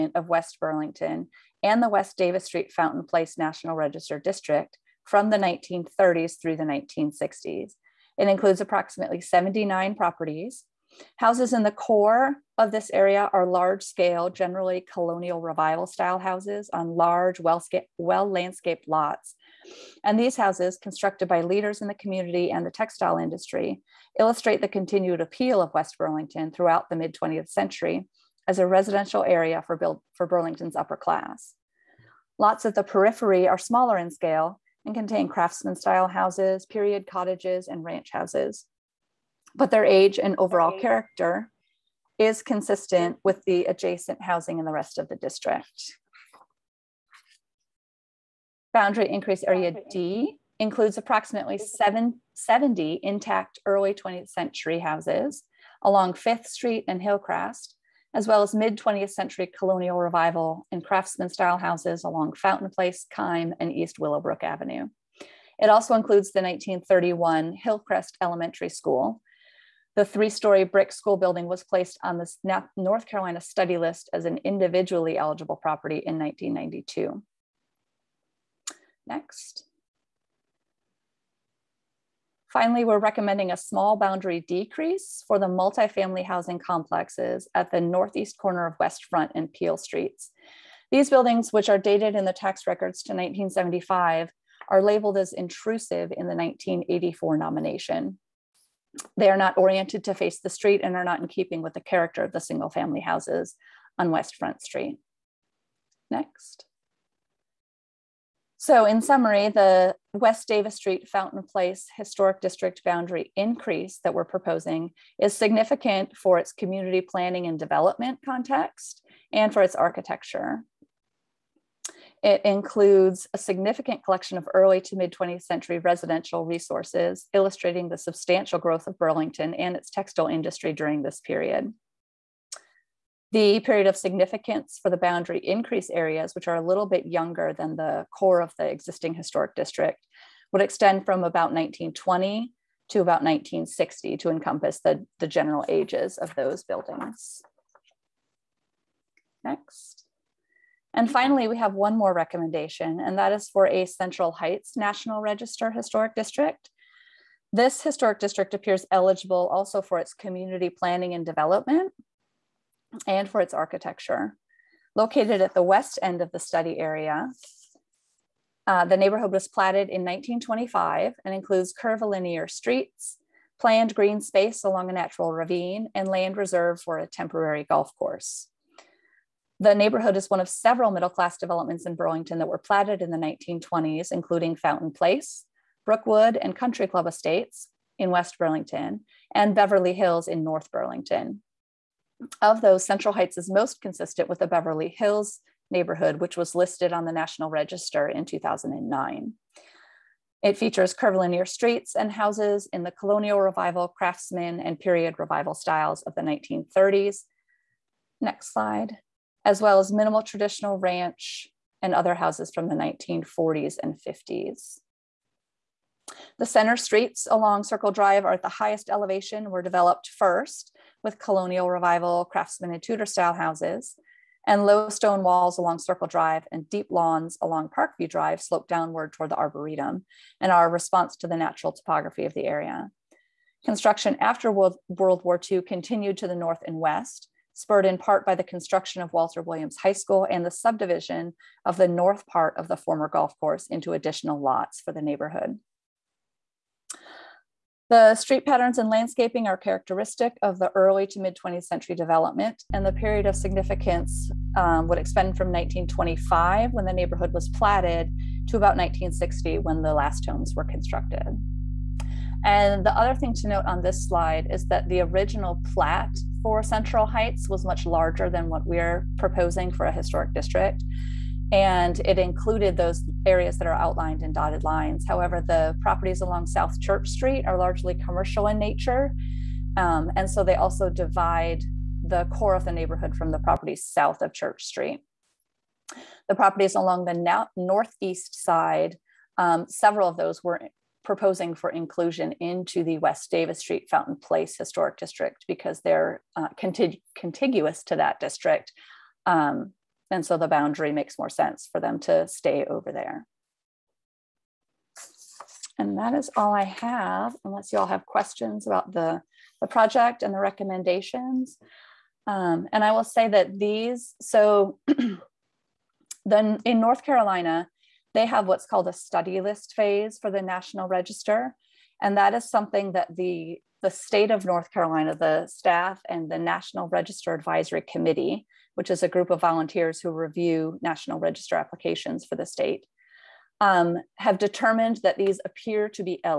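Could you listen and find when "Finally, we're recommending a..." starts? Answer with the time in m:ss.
1:22.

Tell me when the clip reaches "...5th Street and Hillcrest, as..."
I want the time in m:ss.
0:56.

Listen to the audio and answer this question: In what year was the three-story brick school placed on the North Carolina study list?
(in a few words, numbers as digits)
1992.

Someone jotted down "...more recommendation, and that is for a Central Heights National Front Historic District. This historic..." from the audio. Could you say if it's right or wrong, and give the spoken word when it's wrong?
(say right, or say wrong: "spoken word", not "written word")
wrong: "Register", not "Front".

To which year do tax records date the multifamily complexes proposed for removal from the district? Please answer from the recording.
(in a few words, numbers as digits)
1975.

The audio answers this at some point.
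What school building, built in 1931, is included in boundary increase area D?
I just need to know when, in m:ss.
1:07.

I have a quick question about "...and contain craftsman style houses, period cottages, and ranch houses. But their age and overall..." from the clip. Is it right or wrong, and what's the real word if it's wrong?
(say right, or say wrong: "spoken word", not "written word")
right.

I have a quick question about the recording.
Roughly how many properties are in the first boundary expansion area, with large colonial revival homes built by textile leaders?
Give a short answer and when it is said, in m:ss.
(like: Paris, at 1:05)
79, at 0:09.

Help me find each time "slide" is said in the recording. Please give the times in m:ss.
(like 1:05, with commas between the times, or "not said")
3:28, 4:24.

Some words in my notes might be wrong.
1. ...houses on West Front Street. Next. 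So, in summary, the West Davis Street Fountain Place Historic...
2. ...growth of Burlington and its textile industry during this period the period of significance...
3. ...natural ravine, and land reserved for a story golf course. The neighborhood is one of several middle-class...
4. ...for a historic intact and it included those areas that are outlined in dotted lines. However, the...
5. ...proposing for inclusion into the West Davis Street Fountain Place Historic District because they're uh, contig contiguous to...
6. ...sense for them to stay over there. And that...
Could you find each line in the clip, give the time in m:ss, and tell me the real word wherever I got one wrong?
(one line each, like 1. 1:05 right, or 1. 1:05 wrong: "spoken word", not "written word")
1. 1:43 right
2. 2:08 right
3. 2:54 wrong: "temporary", not "story"
4. 4:29 wrong: "district", not "intact"
5. 4:51 right
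6. 5:01 right.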